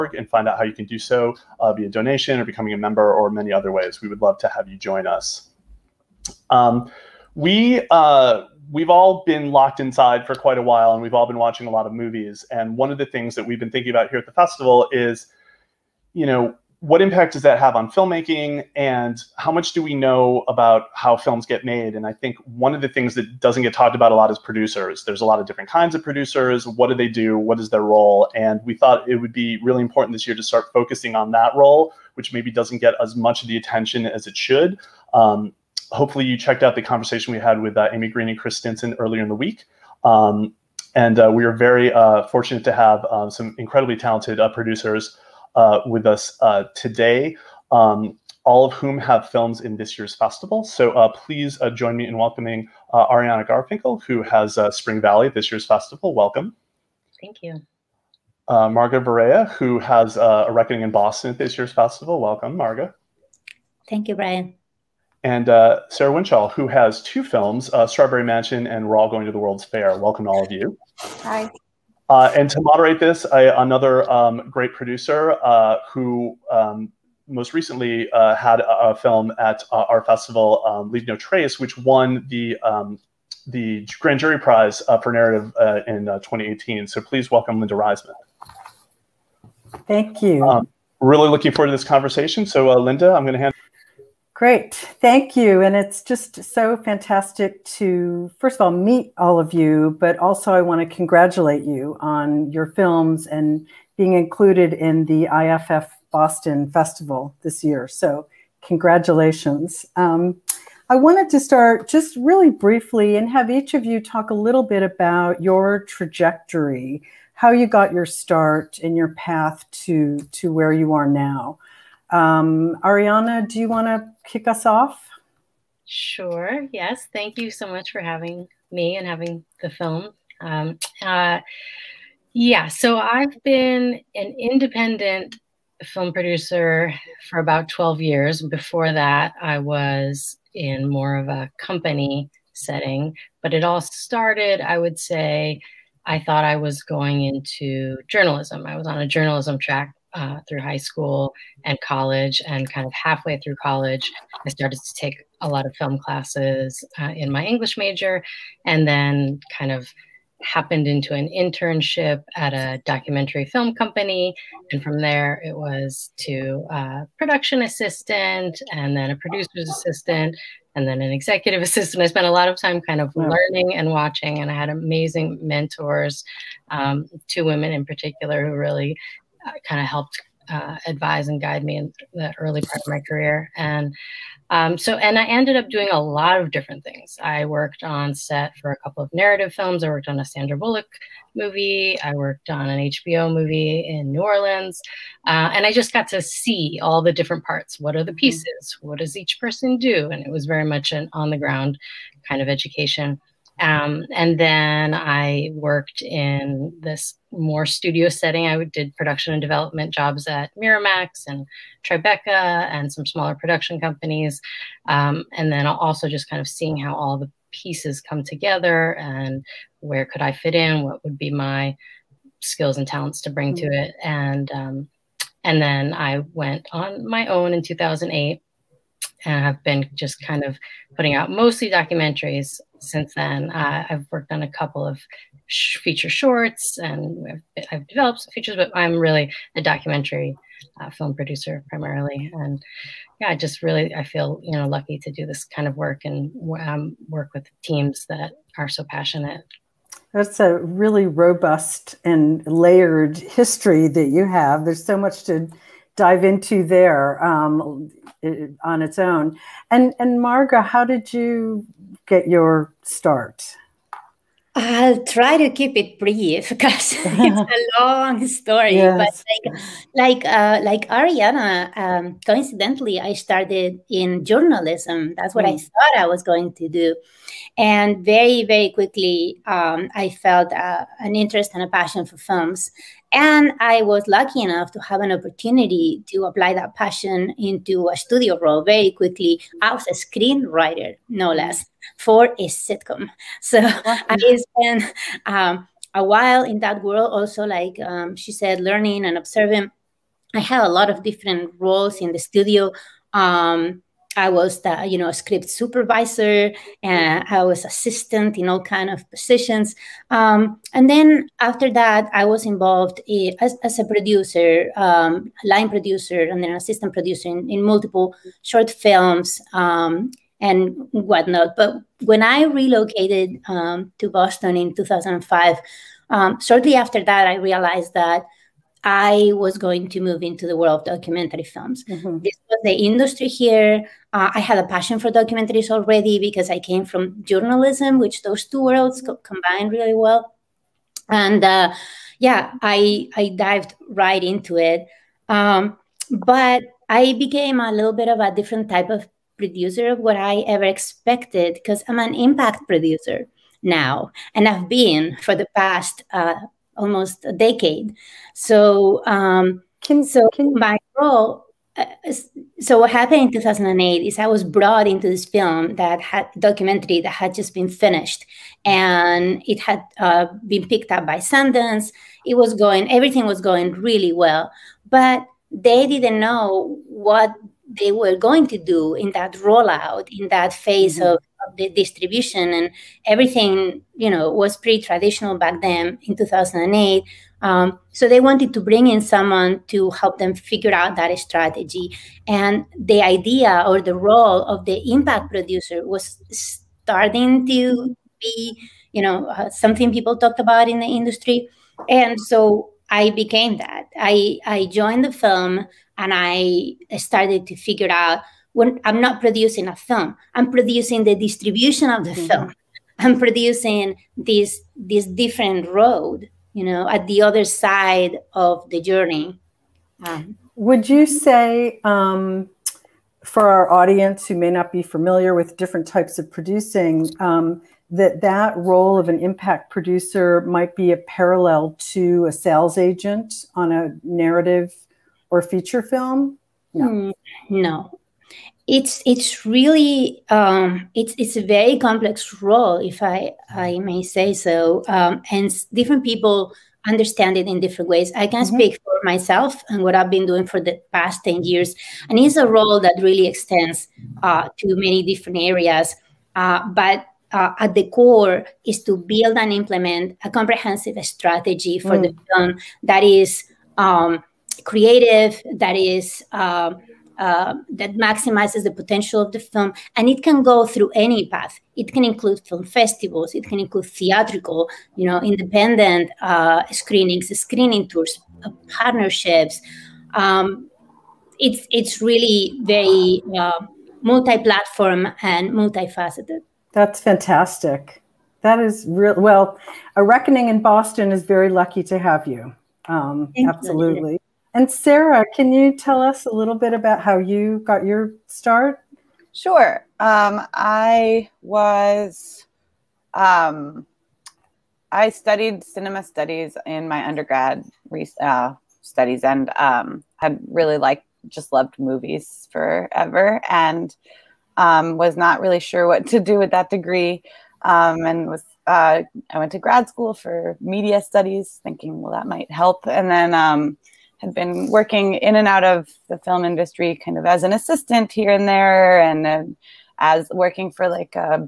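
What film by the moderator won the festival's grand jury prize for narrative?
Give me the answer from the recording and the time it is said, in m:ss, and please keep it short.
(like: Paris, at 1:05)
Leave No Trace, at 1:20.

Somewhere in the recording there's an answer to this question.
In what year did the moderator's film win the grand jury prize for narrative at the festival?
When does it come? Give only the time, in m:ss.
1:26.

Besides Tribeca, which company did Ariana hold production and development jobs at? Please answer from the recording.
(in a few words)
Miramax.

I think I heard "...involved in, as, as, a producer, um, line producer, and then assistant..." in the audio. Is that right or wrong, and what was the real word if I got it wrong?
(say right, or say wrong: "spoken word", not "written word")
right.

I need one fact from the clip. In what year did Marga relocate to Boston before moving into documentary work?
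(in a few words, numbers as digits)
2005.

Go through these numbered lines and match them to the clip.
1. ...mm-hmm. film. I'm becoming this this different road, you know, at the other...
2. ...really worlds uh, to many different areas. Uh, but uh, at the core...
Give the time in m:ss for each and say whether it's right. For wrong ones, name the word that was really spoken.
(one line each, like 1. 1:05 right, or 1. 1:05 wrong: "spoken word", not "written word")
1. 6:52 wrong: "producing", not "becoming"
2. 7:33 wrong: "extends", not "worlds".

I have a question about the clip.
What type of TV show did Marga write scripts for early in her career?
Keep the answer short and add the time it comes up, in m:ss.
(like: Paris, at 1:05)
sitcom, at 4:52.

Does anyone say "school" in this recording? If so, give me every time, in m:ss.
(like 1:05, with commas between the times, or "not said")
2:30, 8:39.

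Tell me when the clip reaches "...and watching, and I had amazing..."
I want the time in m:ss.
2:53.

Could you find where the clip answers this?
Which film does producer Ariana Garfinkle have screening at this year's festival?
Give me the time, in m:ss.
0:54.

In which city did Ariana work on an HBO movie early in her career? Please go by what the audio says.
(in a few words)
New Orleans.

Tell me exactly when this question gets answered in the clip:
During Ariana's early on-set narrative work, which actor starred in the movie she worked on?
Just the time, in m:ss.
3:10.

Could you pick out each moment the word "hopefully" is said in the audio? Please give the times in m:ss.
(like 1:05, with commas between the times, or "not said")
0:35.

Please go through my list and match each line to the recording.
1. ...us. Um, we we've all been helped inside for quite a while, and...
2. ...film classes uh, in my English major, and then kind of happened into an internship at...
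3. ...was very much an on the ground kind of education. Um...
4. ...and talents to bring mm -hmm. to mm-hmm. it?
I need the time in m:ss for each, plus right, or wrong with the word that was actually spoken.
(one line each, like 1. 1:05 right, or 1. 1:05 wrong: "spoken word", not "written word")
1. 0:05 wrong: "locked", not "helped"
2. 2:35 right
3. 3:20 right
4. 3:42 right.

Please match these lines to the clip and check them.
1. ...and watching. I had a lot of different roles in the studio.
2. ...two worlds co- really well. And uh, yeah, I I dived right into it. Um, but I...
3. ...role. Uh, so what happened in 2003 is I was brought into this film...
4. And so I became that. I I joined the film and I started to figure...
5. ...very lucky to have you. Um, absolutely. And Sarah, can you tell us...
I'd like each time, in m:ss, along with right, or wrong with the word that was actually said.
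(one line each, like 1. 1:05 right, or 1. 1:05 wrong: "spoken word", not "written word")
1. 4:59 wrong: "observing", not "watching"
2. 5:38 right
3. 6:00 wrong: "2008", not "2003"
4. 6:41 right
5. 8:11 right.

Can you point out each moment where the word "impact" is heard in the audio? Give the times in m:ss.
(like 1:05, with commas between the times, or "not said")
0:17, 5:52, 6:34, 7:09.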